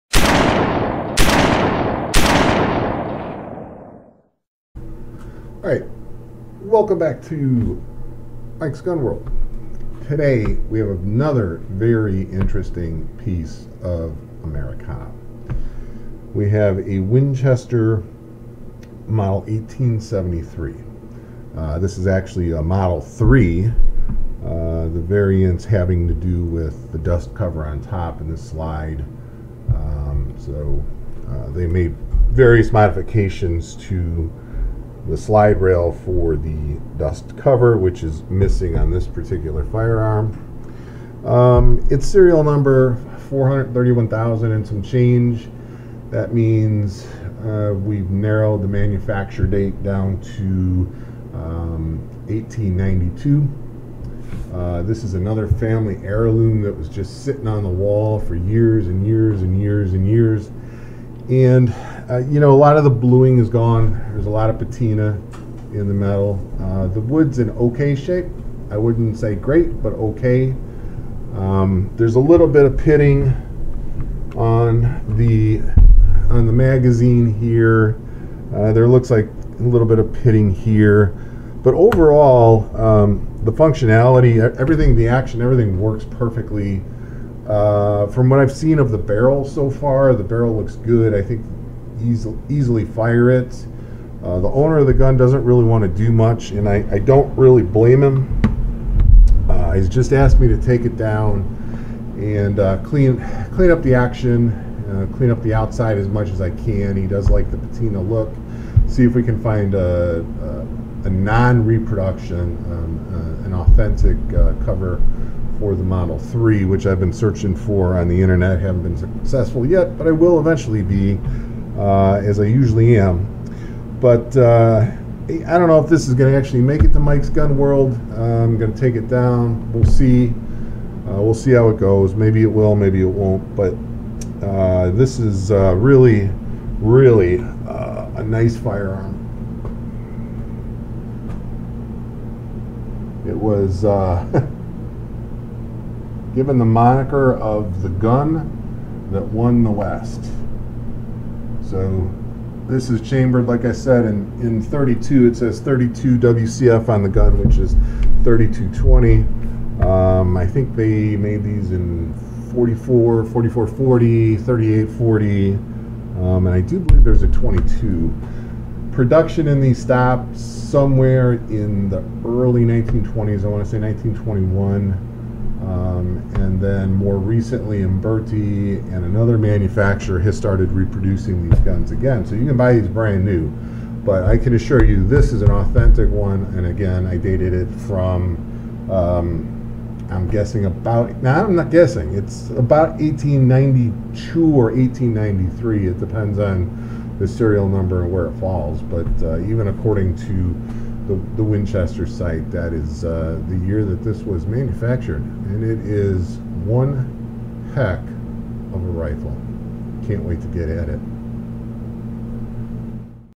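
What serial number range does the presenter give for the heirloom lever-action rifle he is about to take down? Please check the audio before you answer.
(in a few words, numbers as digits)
431,000.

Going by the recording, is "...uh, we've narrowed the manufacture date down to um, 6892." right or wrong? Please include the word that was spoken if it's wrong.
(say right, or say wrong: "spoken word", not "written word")
wrong: "1892", not "6892".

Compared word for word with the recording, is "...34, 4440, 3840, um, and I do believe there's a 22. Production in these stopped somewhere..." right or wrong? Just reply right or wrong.
wrong.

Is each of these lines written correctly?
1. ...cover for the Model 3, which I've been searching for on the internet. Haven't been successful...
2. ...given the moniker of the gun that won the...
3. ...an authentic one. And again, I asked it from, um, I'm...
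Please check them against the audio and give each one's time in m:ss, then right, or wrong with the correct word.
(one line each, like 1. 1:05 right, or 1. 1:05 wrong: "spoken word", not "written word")
1. 1:54 right
2. 2:26 right
3. 3:05 wrong: "dated", not "asked".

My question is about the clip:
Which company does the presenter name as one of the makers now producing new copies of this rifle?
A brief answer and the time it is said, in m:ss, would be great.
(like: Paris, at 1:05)
Uberti, at 2:57.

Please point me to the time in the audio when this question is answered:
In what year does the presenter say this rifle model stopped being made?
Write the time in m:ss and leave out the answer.
2:53.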